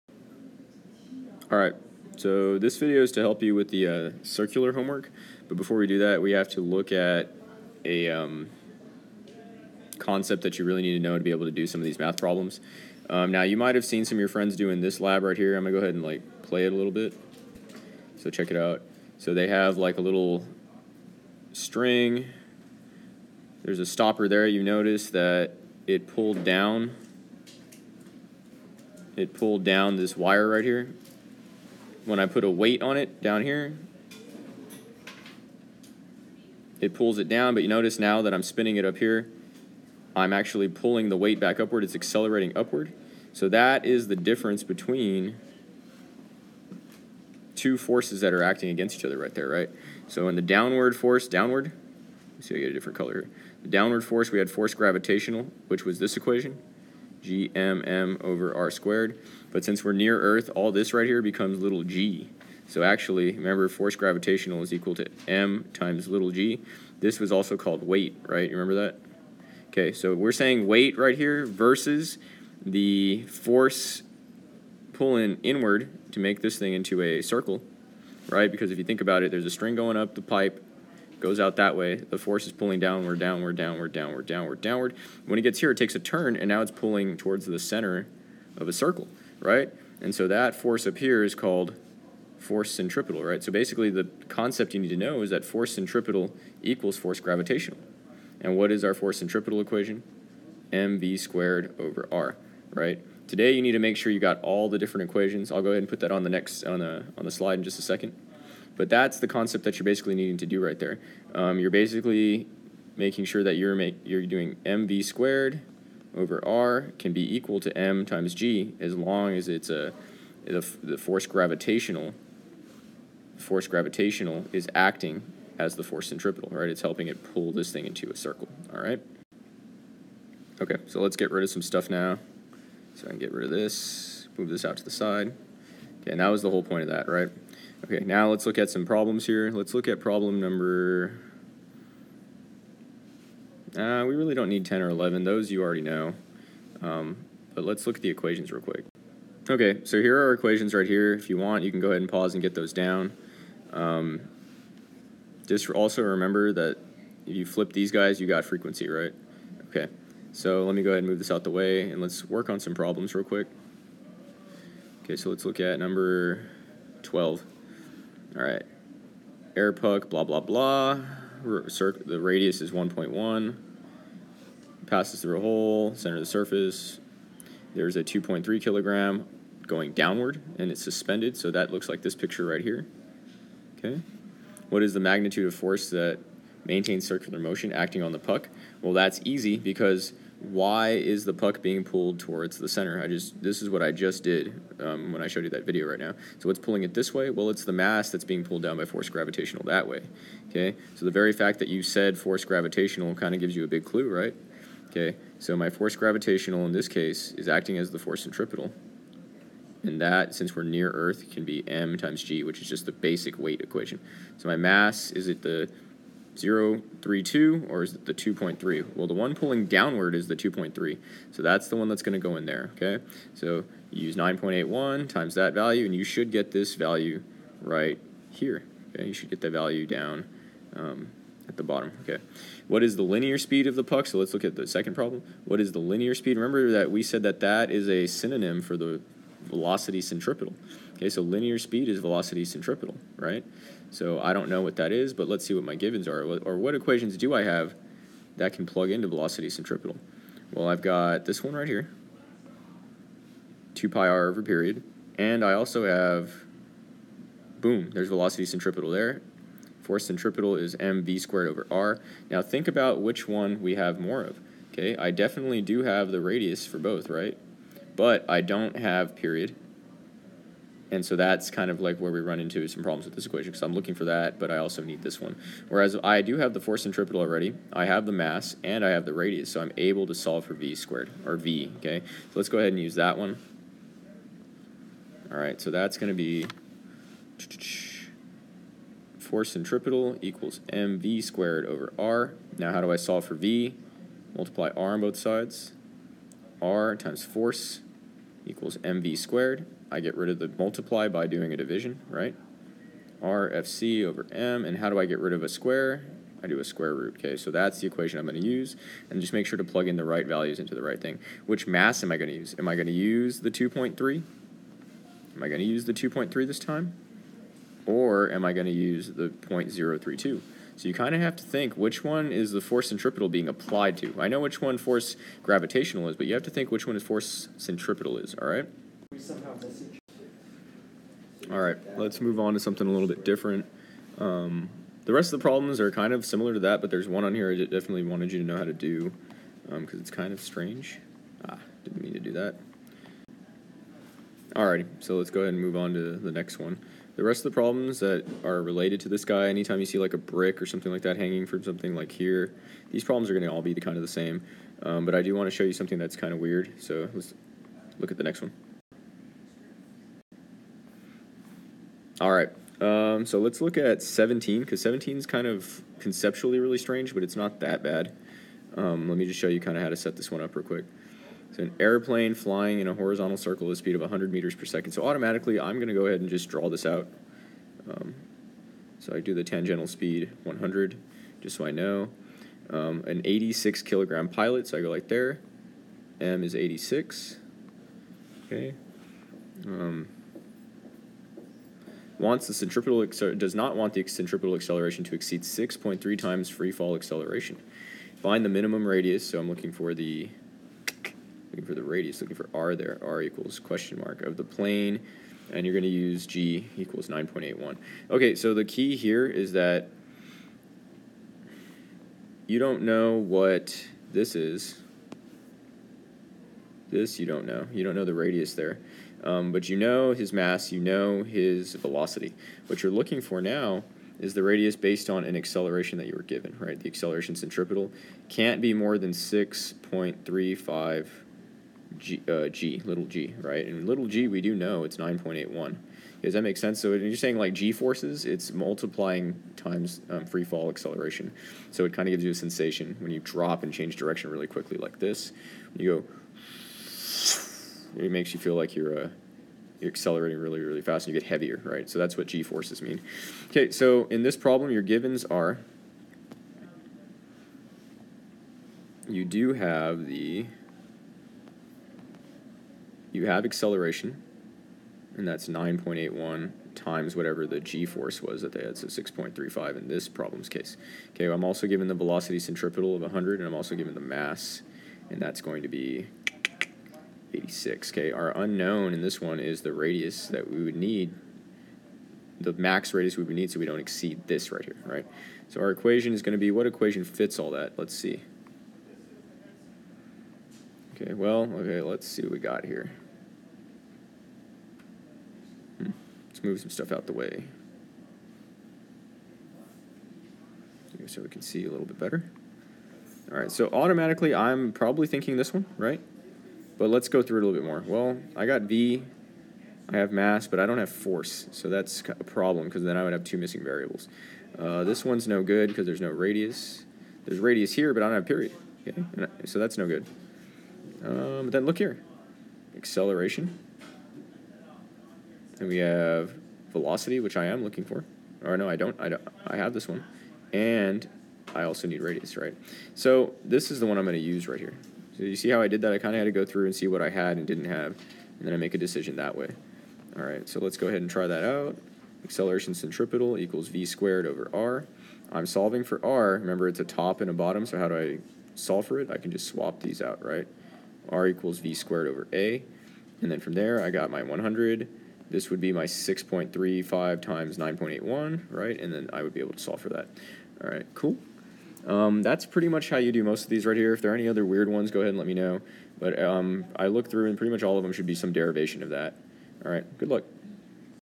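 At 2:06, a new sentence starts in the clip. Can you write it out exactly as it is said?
It's helping it pull this thing into a circle, all right?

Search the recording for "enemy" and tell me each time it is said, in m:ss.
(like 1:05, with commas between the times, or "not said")
not said.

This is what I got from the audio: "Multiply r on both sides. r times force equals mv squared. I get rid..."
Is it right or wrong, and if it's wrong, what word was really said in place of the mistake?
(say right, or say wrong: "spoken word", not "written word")
right.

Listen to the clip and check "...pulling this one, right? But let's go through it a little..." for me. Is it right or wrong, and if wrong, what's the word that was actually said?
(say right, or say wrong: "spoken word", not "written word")
wrong: "thinking", not "pulling".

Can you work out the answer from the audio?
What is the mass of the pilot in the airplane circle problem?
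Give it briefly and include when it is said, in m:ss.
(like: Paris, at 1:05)
86 kilograms, at 6:23.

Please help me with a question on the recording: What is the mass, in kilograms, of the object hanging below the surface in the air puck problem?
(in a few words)
2.3 kilograms.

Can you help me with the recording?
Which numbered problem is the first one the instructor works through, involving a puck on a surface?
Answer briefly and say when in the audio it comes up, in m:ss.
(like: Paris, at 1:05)
12, at 2:45.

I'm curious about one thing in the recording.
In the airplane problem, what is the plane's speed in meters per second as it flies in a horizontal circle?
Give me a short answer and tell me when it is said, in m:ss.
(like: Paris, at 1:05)
100 meters per second, at 6:14.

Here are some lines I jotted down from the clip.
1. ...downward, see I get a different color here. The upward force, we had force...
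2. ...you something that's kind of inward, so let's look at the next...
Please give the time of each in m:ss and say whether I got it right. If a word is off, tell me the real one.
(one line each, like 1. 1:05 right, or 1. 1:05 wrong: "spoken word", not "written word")
1. 0:51 wrong: "downward", not "upward"
2. 5:55 wrong: "weird", not "inward".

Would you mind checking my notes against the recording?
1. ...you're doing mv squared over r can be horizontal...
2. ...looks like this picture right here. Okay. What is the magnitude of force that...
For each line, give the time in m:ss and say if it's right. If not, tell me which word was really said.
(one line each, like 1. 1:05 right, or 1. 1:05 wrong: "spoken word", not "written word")
1. 1:54 wrong: "equal", not "horizontal"
2. 3:01 right.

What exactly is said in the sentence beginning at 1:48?
But that's the concept that you're basically needing to do right there.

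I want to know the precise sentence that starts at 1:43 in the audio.
Today you need to make sure you got all the different equations.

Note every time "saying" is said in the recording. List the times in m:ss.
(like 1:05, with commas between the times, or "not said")
1:10, 7:17.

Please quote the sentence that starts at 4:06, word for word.
Or what equations do I have that can plug into velocity centripetal?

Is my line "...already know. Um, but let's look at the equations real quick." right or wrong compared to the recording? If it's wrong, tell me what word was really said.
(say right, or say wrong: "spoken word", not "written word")
right.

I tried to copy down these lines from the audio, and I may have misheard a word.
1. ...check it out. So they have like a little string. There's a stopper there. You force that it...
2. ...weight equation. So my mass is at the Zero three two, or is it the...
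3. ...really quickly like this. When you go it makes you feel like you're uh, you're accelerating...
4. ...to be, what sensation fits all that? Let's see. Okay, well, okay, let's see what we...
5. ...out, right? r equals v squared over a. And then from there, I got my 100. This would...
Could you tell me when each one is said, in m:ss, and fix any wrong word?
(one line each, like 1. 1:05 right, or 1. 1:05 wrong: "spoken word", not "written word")
1. 0:18 wrong: "notice", not "force"
2. 3:33 right
3. 7:24 right
4. 8:06 wrong: "equation", not "sensation"
5. 9:10 right.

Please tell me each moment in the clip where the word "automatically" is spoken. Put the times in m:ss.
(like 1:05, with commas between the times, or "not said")
6:15, 8:23.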